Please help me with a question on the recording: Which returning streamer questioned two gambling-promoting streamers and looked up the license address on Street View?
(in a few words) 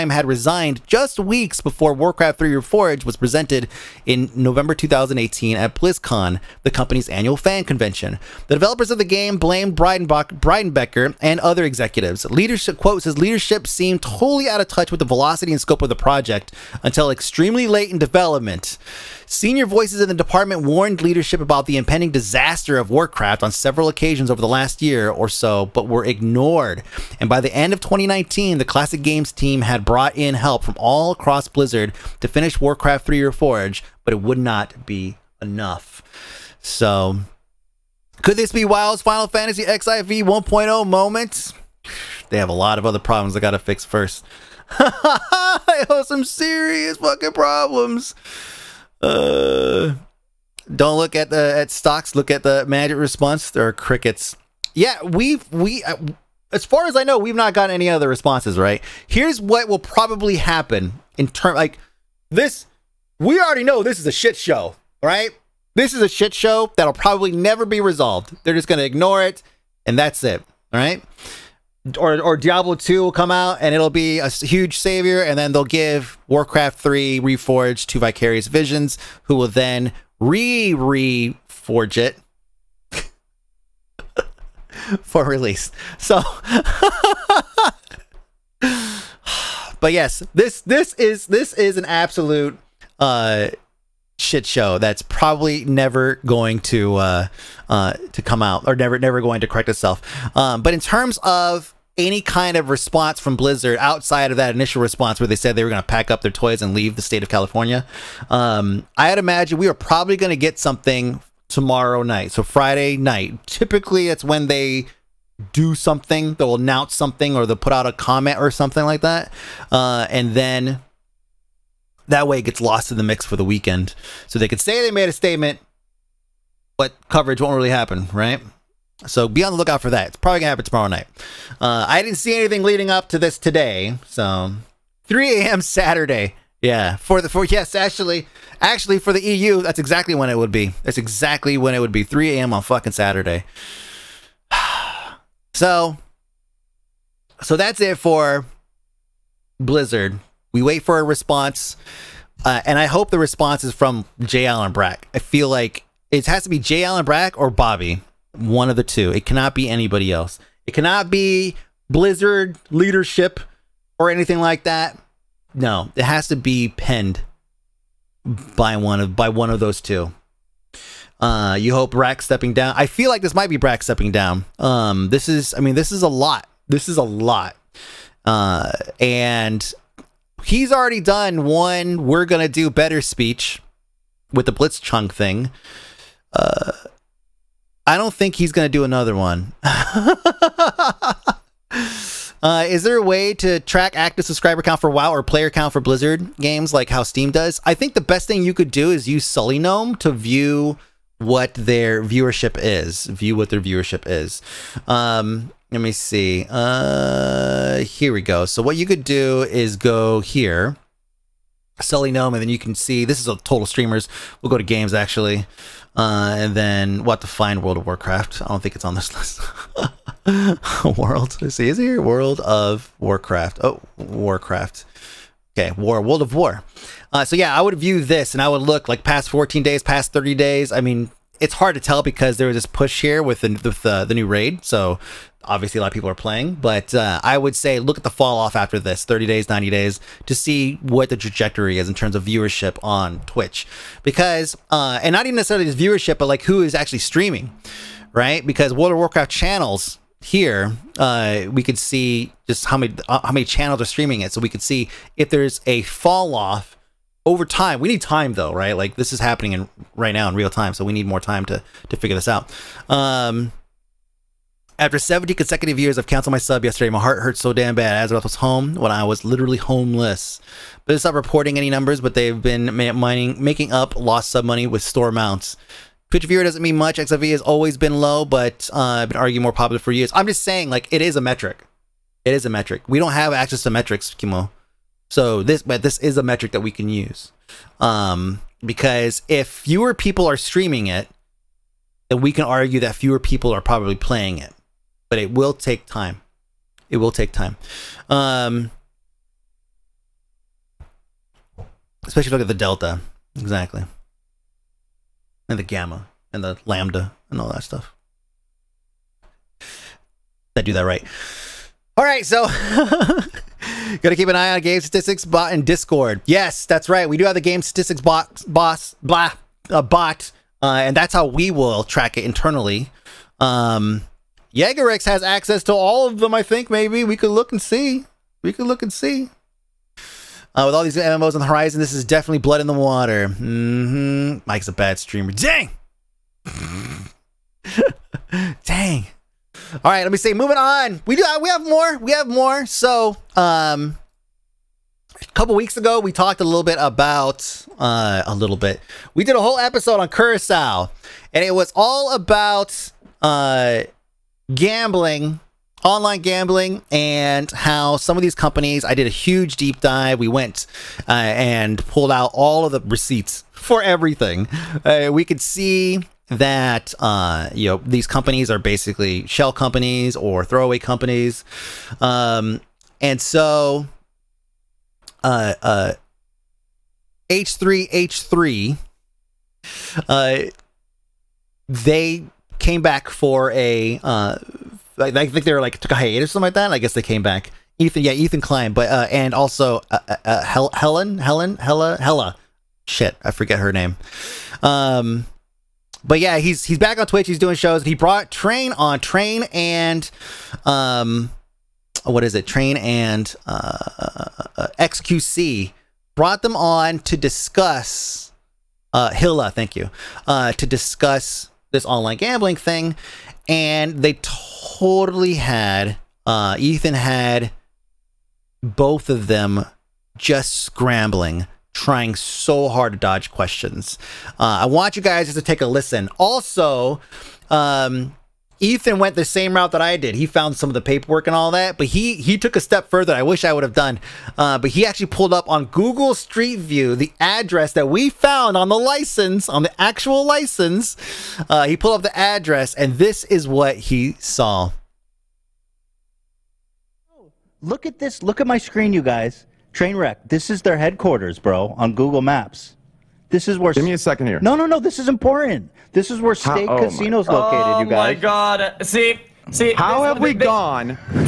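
Ethan Klein.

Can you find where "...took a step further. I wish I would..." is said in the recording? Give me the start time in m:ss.
7:12.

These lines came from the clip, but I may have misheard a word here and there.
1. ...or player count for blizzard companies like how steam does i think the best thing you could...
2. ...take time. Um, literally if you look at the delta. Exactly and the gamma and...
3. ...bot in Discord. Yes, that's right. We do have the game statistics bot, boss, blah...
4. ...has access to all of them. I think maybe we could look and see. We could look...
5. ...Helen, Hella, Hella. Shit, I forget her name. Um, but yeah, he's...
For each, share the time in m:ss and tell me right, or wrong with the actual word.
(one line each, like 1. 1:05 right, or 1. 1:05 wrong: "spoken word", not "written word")
1. 3:15 wrong: "games", not "companies"
2. 4:57 wrong: "especially", not "literally"
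3. 5:15 right
4. 5:25 right
5. 6:31 right.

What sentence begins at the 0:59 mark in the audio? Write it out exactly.
Here's what will probably happen in term like this.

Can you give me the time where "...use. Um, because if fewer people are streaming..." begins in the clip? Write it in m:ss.
4:46.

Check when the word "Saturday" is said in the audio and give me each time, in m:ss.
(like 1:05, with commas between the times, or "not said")
2:15, 2:22.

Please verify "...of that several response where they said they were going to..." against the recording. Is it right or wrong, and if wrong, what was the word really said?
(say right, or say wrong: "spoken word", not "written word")
wrong: "initial", not "several".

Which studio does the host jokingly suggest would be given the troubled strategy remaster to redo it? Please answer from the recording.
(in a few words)
Vicarious Visions.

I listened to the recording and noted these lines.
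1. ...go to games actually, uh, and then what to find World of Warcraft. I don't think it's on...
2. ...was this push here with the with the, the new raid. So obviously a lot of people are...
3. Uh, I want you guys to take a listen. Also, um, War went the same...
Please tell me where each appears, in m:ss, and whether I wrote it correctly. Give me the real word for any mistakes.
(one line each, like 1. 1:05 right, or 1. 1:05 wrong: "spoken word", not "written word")
1. 3:34 right
2. 3:52 right
3. 7:04 wrong: "Ethan", not "War".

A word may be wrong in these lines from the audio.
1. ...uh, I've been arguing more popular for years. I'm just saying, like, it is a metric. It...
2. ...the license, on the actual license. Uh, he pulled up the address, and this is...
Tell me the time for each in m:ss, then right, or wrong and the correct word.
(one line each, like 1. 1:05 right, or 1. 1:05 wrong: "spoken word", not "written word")
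1. 4:38 right
2. 7:18 right.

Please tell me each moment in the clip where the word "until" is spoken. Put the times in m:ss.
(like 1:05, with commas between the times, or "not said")
0:16.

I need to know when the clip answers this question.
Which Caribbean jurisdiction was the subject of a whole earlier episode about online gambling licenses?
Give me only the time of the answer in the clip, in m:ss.
5:50.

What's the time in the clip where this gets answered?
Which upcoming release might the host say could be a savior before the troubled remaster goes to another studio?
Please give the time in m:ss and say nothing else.
1:12.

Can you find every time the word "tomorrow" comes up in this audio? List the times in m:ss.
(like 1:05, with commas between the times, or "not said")
1:51, 2:10.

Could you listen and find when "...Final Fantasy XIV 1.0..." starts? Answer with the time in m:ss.
0:39.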